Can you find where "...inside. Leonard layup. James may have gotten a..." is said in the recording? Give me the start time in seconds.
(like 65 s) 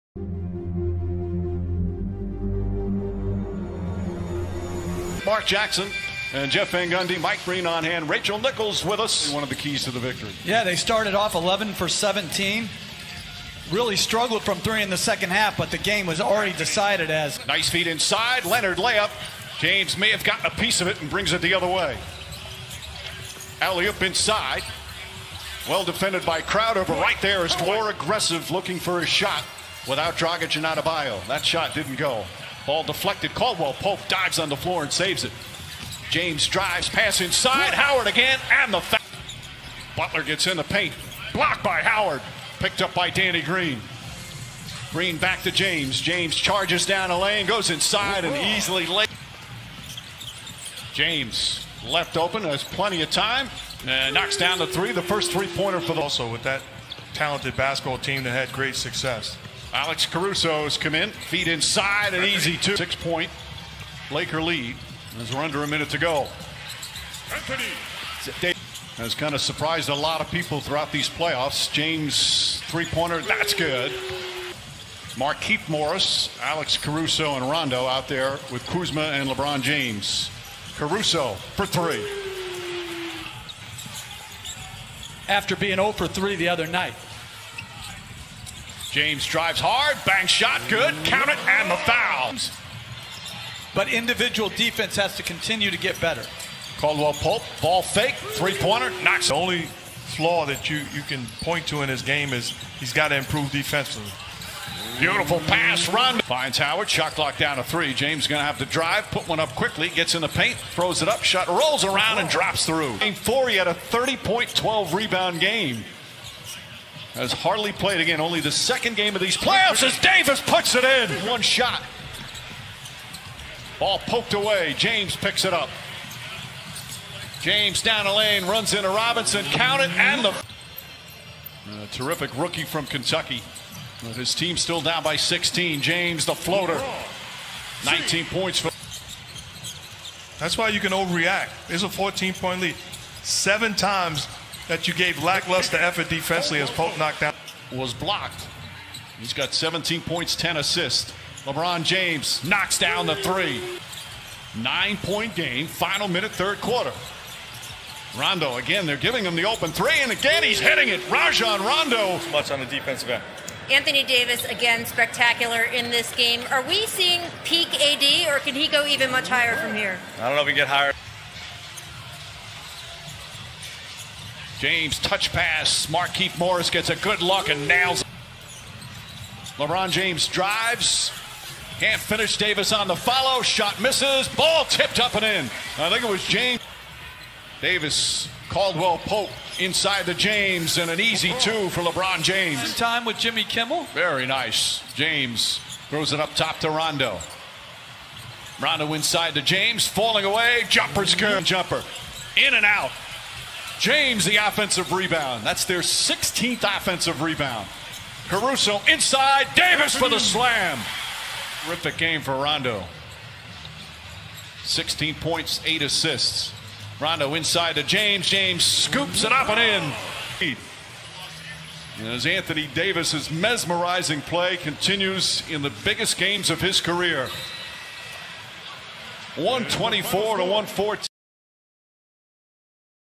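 17 s.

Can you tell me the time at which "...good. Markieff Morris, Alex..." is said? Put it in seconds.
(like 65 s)
73 s.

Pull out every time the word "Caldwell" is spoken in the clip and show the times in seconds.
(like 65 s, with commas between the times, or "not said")
33 s, 96 s, 188 s.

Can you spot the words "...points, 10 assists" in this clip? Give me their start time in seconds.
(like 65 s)
150 s.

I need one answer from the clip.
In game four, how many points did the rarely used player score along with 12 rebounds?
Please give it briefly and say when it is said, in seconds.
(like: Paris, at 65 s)
30, at 113 s.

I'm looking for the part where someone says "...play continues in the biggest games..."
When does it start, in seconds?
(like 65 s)
224 s.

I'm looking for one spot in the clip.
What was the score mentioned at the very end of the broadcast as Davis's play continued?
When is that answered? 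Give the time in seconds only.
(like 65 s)
229 s.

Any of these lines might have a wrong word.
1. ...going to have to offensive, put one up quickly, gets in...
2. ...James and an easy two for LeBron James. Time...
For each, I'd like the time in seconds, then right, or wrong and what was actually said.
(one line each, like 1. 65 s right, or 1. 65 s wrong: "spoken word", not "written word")
1. 108 s wrong: "drive", not "offensive"
2. 190 s right.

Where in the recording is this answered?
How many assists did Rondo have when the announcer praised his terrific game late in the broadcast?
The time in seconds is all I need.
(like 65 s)
215 s.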